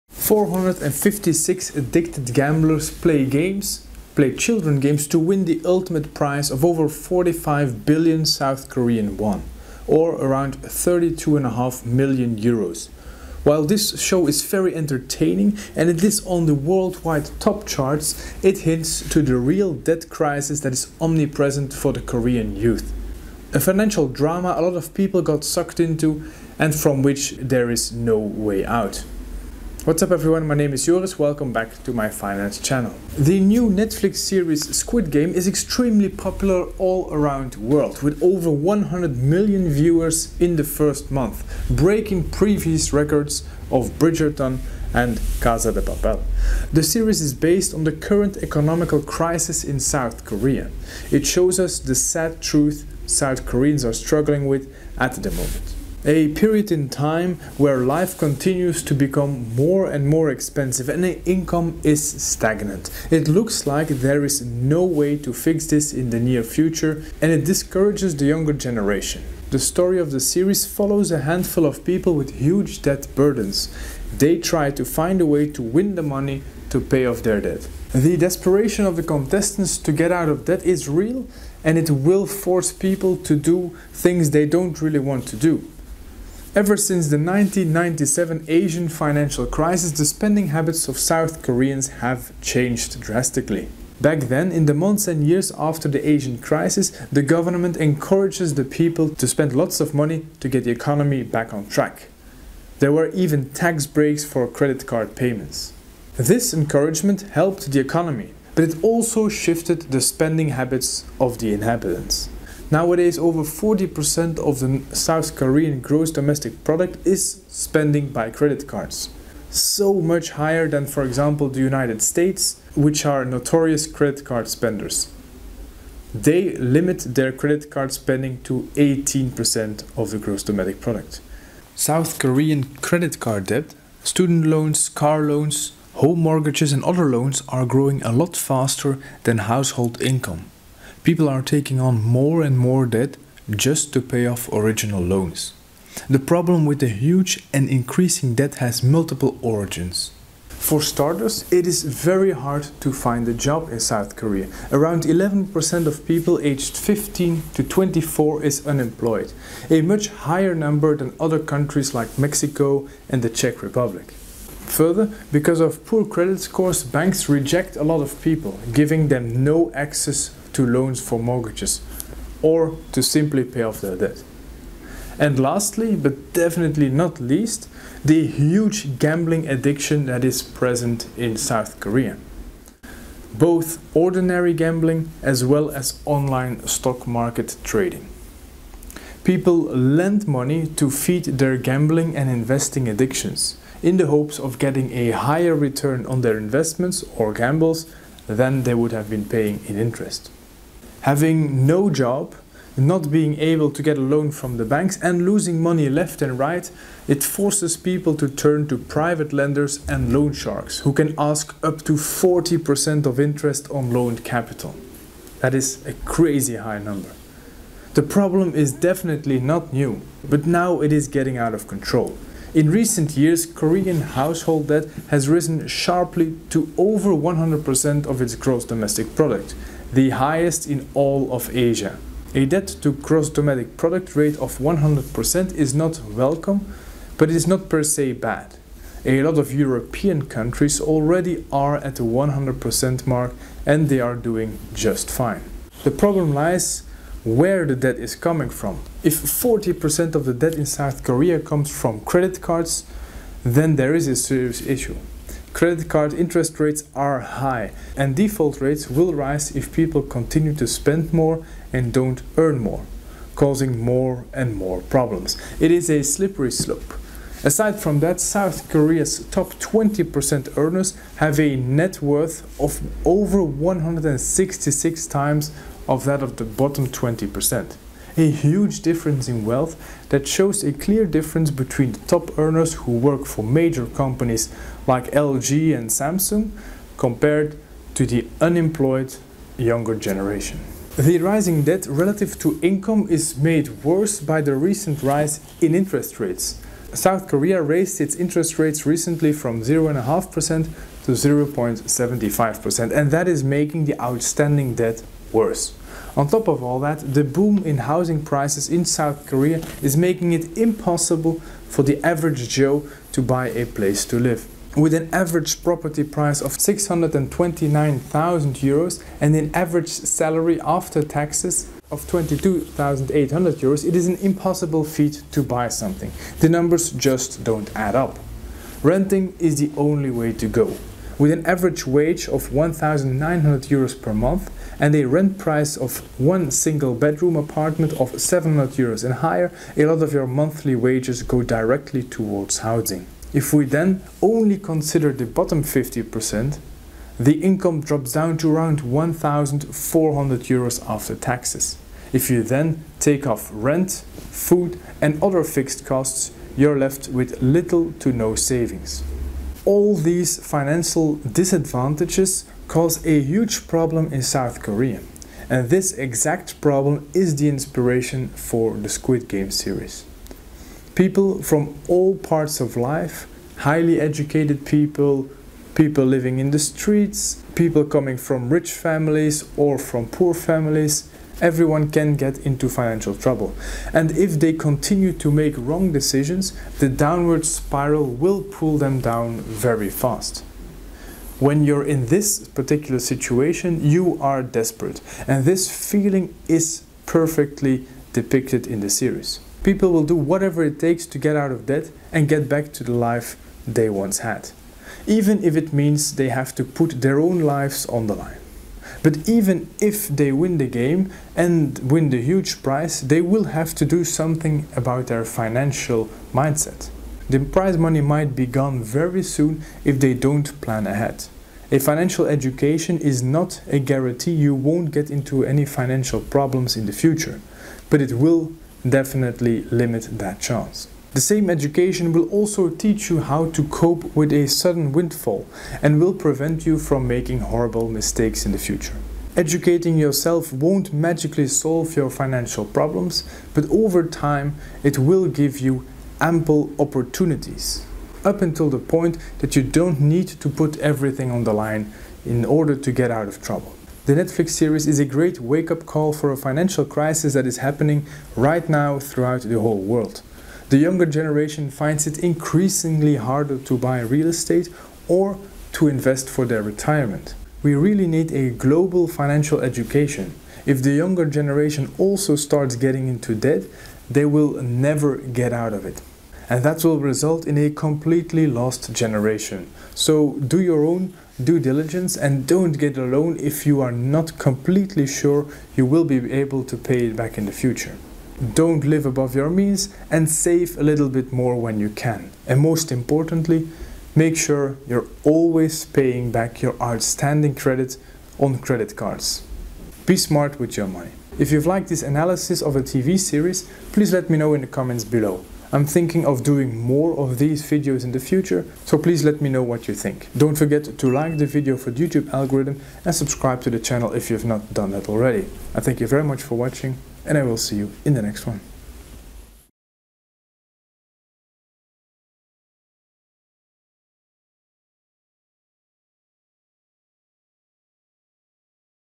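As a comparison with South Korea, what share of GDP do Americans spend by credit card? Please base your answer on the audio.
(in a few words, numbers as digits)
18%.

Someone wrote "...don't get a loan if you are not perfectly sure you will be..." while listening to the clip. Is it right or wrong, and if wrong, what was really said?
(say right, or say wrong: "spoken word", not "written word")
wrong: "completely", not "perfectly".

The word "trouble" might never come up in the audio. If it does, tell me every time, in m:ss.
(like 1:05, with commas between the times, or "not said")
6:23, 7:33.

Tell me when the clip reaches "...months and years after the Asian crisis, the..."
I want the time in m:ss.
1:34.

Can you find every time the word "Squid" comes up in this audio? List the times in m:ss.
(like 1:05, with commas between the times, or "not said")
0:34, 6:08.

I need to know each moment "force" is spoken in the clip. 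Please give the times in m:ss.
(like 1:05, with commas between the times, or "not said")
1:22, 3:27.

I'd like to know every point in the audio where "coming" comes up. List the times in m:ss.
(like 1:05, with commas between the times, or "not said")
4:08, 6:17.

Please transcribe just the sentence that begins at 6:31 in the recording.
When you're in this particular situation, you are desperate.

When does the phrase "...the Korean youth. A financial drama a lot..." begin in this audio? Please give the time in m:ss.
0:21.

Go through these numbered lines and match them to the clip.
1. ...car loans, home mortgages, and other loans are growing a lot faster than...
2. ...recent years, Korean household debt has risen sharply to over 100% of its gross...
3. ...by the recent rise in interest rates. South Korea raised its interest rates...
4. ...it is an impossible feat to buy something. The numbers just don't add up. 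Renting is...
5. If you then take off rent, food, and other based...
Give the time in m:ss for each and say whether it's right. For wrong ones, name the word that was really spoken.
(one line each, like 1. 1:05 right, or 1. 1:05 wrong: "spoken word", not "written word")
1. 2:14 right
2. 3:42 right
3. 4:54 right
4. 5:23 right
5. 5:52 wrong: "fixed", not "based".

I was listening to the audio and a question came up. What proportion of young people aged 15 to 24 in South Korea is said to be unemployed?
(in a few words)
around 11%.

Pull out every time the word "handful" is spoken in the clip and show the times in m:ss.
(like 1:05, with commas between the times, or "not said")
1:11.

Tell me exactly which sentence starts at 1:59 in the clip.
So much higher than, for example, the United States, which are notorious credit card spenders.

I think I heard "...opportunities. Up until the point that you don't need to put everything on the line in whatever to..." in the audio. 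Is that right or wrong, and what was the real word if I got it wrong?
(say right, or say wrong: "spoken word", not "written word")
wrong: "order", not "whatever".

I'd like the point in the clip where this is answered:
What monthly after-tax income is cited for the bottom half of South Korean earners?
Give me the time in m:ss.
5:48.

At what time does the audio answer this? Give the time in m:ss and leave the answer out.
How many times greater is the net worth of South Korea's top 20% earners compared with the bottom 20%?
4:33.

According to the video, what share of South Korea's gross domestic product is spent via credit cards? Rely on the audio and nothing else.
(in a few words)
over 40%.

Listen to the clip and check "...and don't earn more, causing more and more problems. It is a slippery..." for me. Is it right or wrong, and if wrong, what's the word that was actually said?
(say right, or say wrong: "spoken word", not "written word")
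right.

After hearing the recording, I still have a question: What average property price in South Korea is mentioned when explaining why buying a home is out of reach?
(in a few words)
629,000 euros.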